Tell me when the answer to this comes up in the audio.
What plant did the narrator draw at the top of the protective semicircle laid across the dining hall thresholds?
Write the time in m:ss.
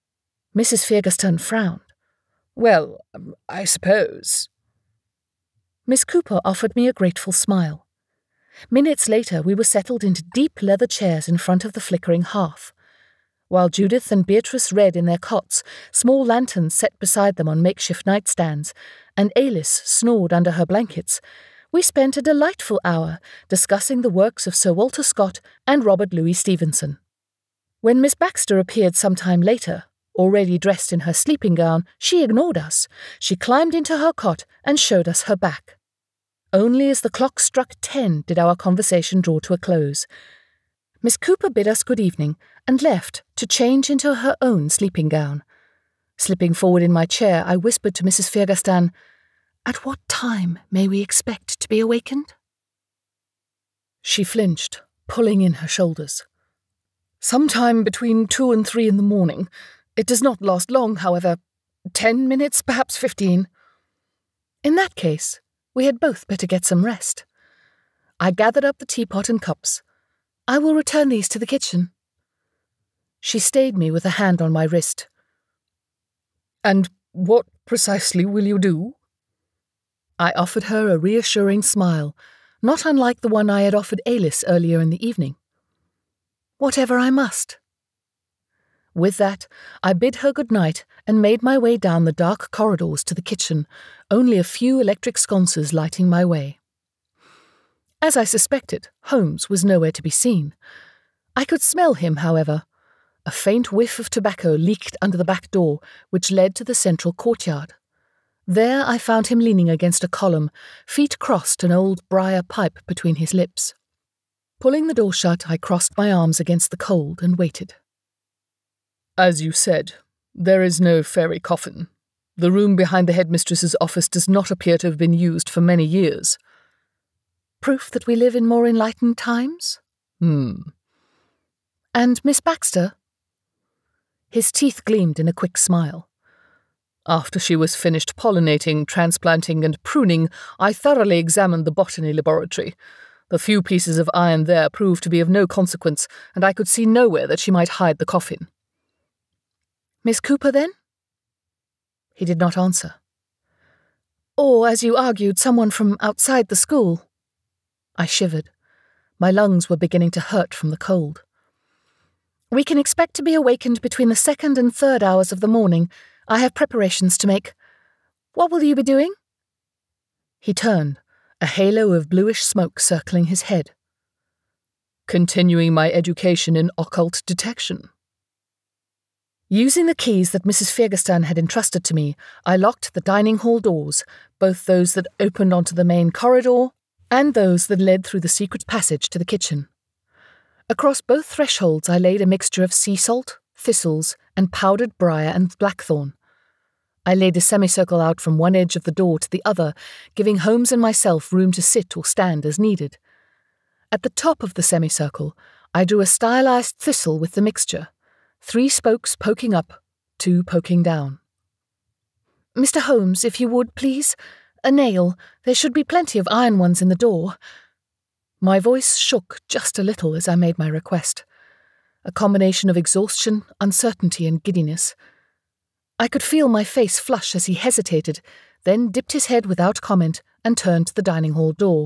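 3:26.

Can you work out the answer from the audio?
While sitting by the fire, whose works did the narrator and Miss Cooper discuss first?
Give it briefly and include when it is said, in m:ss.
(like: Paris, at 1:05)
Sir Walter Scott, at 0:24.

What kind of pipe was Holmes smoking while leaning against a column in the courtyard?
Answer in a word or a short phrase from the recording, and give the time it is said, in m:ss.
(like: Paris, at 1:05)
briar pipe, at 1:52.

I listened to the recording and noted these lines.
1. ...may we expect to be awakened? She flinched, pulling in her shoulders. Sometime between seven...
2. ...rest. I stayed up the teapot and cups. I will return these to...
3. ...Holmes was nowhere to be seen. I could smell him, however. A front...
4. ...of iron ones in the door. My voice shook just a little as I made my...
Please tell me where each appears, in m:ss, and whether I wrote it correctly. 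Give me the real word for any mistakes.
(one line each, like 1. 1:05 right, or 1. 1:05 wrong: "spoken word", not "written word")
1. 0:50 wrong: "two", not "seven"
2. 1:06 wrong: "gathered", not "stayed"
3. 1:39 wrong: "faint", not "front"
4. 3:36 right.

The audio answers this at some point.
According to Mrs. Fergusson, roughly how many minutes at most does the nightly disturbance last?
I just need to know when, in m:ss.
1:02.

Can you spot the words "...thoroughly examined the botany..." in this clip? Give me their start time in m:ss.
2:20.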